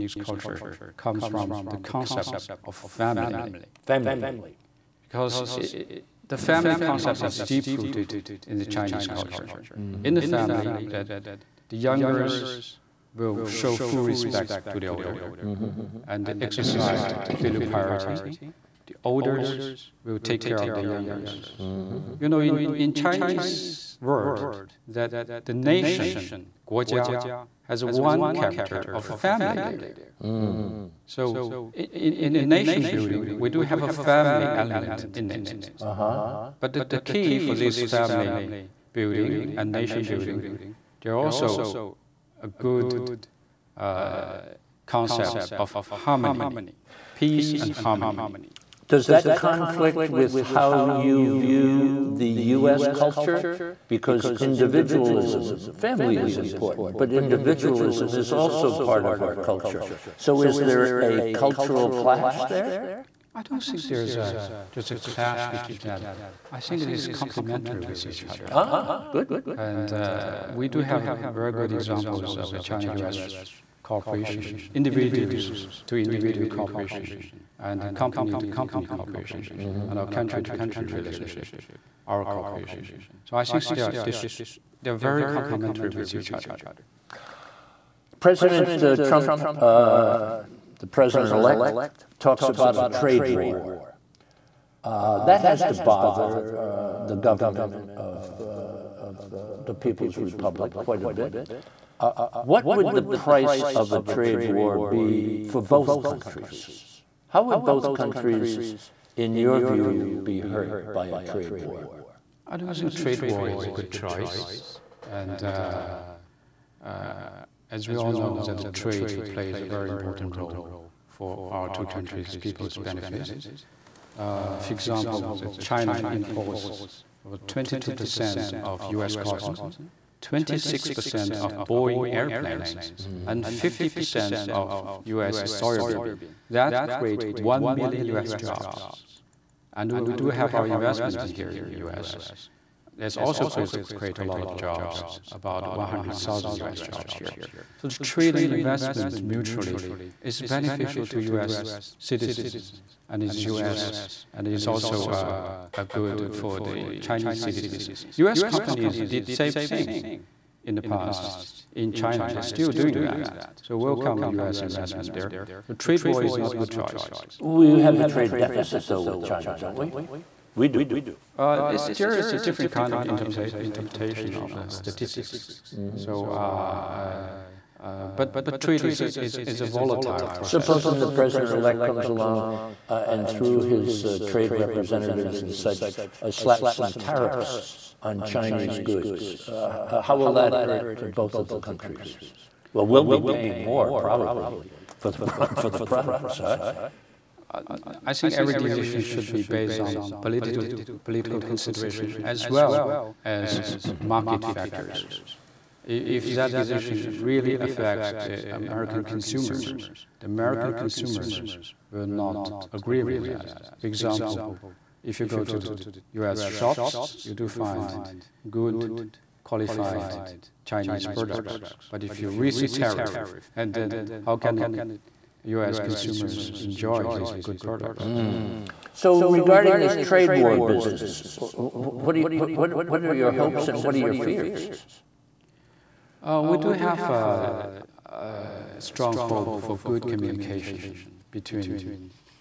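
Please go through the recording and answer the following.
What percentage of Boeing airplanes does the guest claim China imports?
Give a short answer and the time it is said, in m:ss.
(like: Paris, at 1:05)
26%, at 2:10.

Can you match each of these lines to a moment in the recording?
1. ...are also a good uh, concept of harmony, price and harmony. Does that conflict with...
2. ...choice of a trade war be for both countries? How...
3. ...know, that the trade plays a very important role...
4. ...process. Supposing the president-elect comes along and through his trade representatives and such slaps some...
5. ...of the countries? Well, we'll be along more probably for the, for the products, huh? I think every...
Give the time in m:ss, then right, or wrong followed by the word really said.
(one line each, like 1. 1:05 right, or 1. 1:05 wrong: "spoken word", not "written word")
1. 0:41 wrong: "peace", not "price"
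2. 1:43 wrong: "price", not "choice"
3. 1:58 right
4. 3:00 right
5. 3:11 wrong: "paying", not "along".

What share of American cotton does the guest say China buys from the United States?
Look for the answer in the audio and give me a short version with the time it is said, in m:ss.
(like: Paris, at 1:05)
22%, at 2:07.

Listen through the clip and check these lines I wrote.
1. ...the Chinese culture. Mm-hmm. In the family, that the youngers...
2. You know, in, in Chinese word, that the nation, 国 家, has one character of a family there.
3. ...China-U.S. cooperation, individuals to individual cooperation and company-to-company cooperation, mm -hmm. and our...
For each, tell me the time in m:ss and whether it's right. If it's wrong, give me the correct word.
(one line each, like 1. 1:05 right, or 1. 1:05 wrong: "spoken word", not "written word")
1. 0:08 right
2. 0:22 right
3. 1:12 right.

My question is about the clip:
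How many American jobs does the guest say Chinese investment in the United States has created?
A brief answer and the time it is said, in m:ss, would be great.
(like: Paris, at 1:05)
100,000, at 2:25.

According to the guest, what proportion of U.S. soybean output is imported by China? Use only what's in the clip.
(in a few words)
50%.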